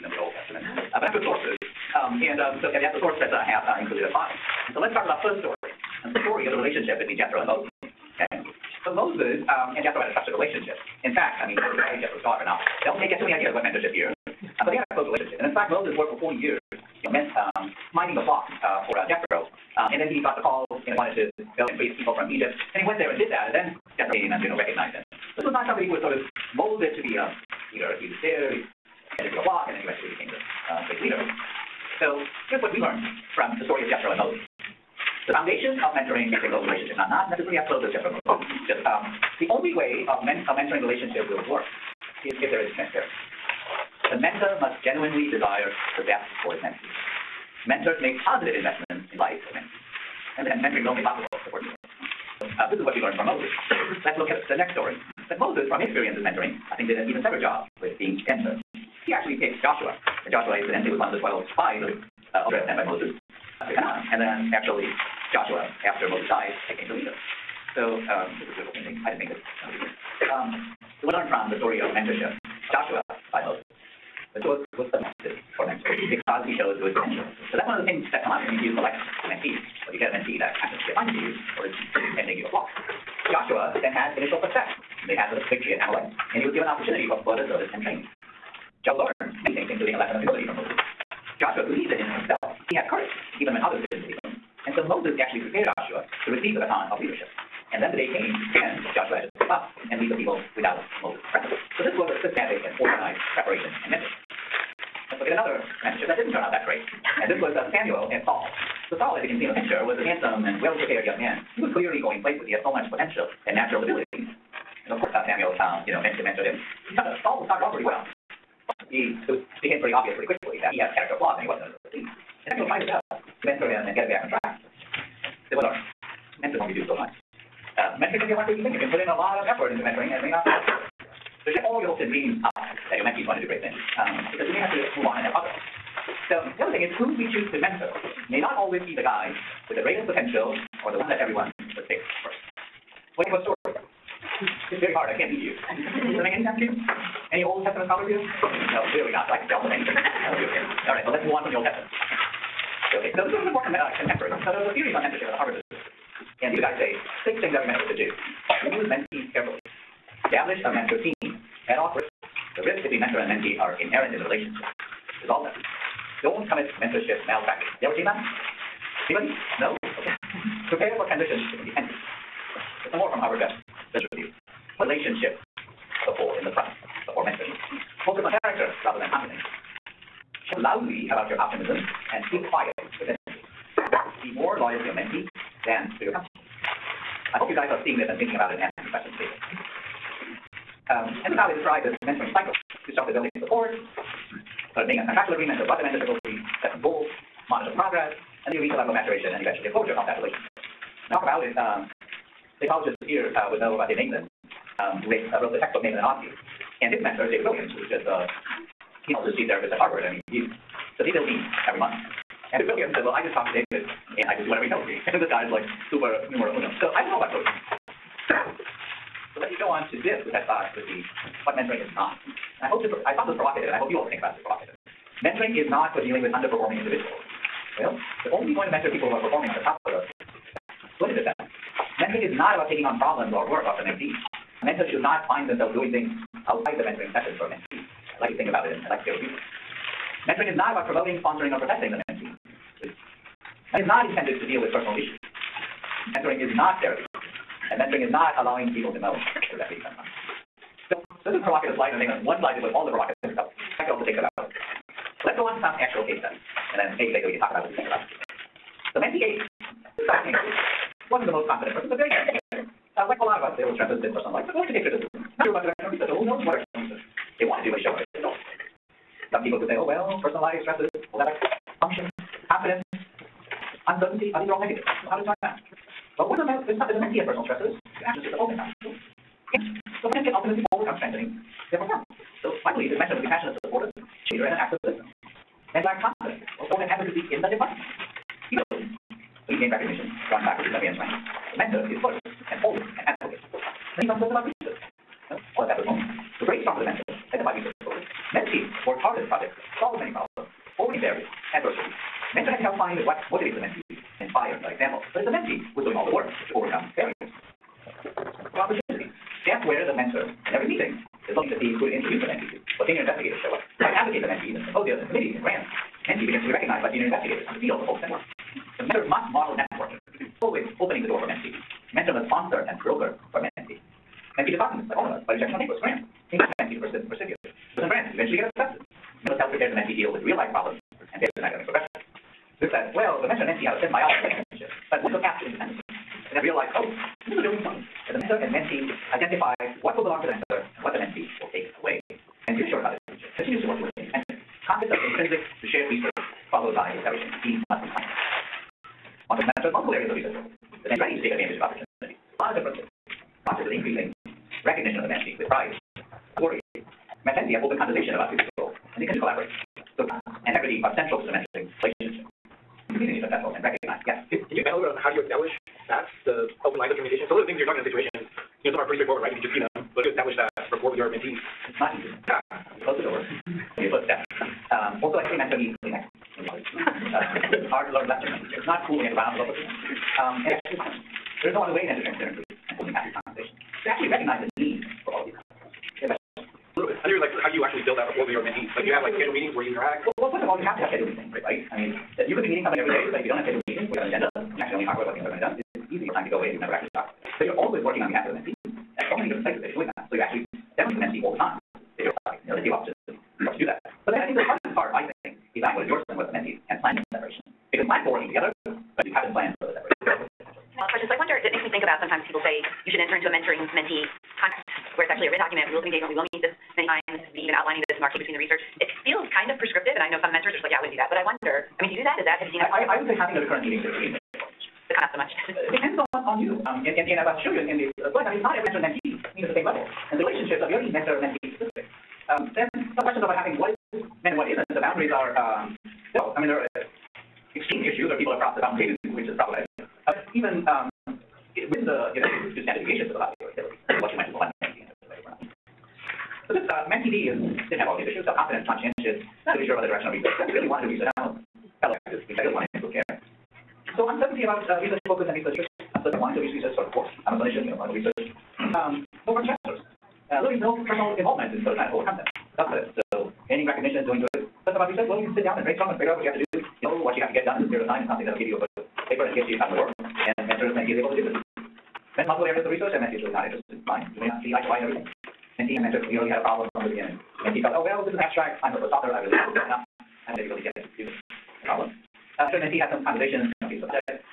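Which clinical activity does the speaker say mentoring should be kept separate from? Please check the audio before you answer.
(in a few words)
Therapy.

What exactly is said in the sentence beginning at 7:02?
Is that, have you seen that?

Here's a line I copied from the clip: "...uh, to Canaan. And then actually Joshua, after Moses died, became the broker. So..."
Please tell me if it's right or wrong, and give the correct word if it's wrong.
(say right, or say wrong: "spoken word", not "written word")
wrong: "leader", not "broker".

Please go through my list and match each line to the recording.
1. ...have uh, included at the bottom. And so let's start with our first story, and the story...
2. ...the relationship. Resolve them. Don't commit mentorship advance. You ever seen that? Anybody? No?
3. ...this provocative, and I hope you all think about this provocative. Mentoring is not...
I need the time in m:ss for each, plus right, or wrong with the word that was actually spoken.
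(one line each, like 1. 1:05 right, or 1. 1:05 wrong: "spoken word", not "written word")
1. 0:03 right
2. 2:44 wrong: "malpractice", not "advance"
3. 3:43 right.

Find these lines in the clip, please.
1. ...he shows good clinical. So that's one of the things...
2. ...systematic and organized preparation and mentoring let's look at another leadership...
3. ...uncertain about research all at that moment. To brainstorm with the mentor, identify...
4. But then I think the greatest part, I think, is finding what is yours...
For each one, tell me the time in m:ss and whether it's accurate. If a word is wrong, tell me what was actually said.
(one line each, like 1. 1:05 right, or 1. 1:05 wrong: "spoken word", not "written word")
1. 1:16 wrong: "potential", not "clinical"
2. 1:42 wrong: "mentorship", not "leadership"
3. 4:54 right
4. 6:44 wrong: "hardest", not "greatest".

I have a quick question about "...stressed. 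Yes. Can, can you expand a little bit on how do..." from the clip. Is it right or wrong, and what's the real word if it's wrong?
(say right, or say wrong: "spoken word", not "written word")
wrong: "recognized", not "stressed".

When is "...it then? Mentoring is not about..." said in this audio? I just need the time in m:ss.
3:51.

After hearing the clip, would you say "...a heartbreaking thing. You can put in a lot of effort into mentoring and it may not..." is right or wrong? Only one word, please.
right.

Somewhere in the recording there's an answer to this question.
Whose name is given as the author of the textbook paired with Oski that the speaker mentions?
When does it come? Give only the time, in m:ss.
3:23.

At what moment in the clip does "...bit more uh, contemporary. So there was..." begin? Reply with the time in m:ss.
2:33.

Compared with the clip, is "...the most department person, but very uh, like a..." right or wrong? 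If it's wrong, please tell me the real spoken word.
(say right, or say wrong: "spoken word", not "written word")
wrong: "confident", not "department".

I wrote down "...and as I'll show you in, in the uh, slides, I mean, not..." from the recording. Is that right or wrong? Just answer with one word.
right.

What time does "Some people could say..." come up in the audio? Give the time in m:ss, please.
4:29.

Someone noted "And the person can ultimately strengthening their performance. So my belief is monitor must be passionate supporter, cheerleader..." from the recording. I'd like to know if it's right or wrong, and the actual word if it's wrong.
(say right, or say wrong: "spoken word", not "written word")
wrong: "mentor", not "monitor".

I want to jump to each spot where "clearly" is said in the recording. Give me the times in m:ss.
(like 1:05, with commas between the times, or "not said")
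1:51, 2:28, 7:56.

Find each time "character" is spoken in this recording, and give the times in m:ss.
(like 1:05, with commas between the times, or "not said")
2:00, 2:58.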